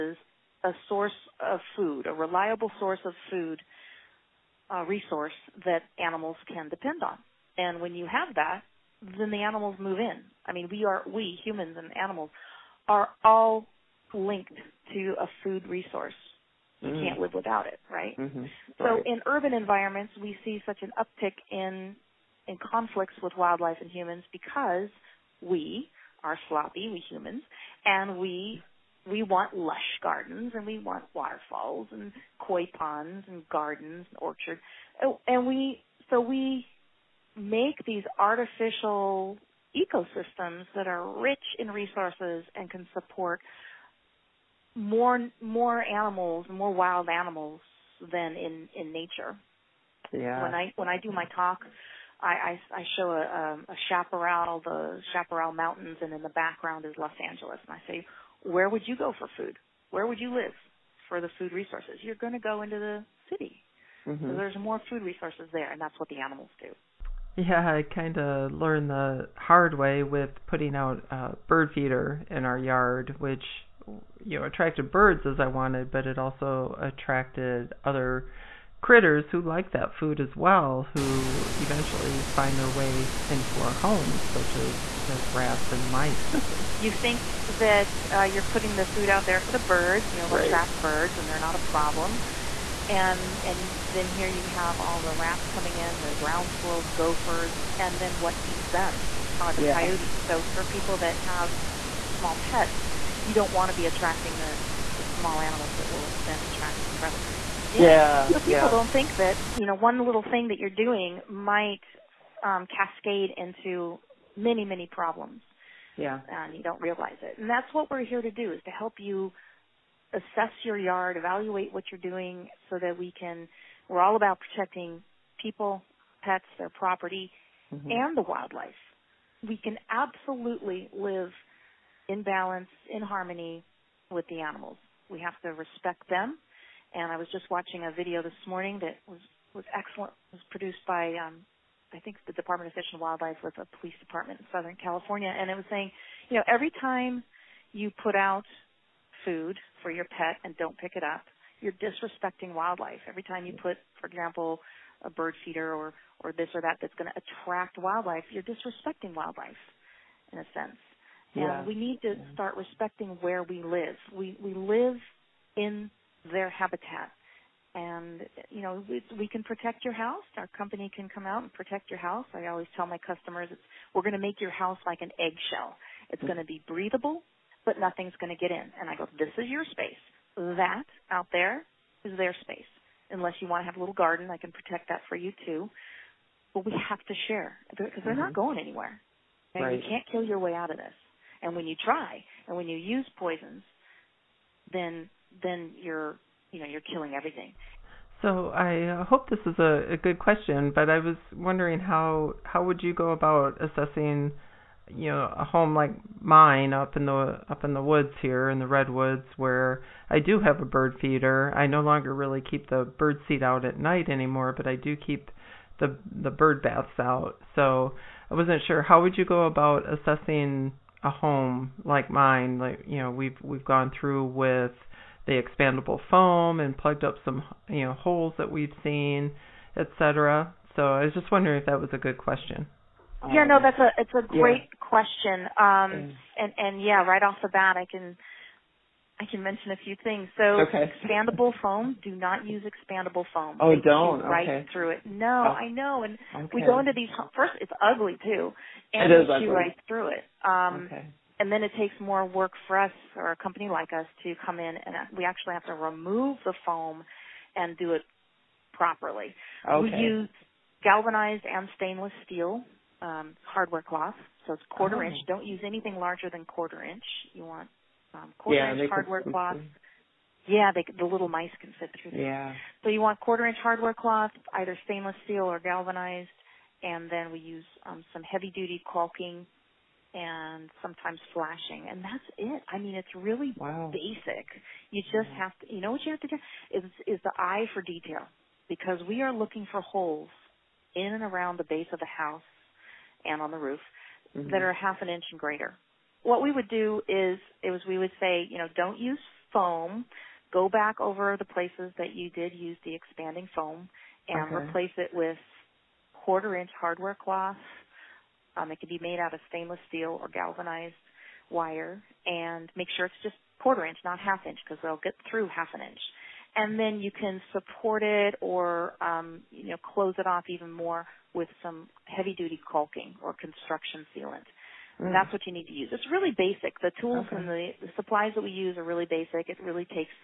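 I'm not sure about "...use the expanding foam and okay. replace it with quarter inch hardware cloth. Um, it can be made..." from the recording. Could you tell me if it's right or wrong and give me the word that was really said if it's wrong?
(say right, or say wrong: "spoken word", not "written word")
right.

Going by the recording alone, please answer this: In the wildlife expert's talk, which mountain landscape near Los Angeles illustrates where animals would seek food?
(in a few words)
Chaparral Mountains.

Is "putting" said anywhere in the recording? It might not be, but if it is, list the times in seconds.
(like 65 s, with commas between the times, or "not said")
70 s, 88 s.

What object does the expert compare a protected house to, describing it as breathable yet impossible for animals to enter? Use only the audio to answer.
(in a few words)
eggshell.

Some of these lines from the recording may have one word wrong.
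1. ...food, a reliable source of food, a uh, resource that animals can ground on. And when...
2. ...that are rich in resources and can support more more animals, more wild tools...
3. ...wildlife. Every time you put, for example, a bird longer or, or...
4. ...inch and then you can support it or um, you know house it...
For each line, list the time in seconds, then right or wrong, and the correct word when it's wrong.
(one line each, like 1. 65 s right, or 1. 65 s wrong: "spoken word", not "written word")
1. 1 s wrong: "depend", not "ground"
2. 40 s wrong: "animals", not "tools"
3. 152 s wrong: "feeder", not "longer"
4. 315 s wrong: "close", not "house".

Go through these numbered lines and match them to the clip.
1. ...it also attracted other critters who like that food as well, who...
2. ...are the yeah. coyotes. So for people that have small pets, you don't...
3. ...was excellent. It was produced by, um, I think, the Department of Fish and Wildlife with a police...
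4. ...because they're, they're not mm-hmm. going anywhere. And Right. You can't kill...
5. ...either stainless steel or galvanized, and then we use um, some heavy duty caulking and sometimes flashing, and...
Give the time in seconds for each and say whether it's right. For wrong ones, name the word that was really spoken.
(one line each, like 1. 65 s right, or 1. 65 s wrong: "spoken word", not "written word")
1. 76 s right
2. 99 s right
3. 139 s right
4. 187 s right
5. 274 s right.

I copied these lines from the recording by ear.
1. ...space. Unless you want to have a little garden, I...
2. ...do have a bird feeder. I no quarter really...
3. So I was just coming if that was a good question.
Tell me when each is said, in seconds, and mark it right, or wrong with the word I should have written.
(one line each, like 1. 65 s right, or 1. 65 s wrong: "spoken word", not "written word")
1. 182 s right
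2. 210 s wrong: "longer", not "quarter"
3. 230 s wrong: "wondering", not "coming".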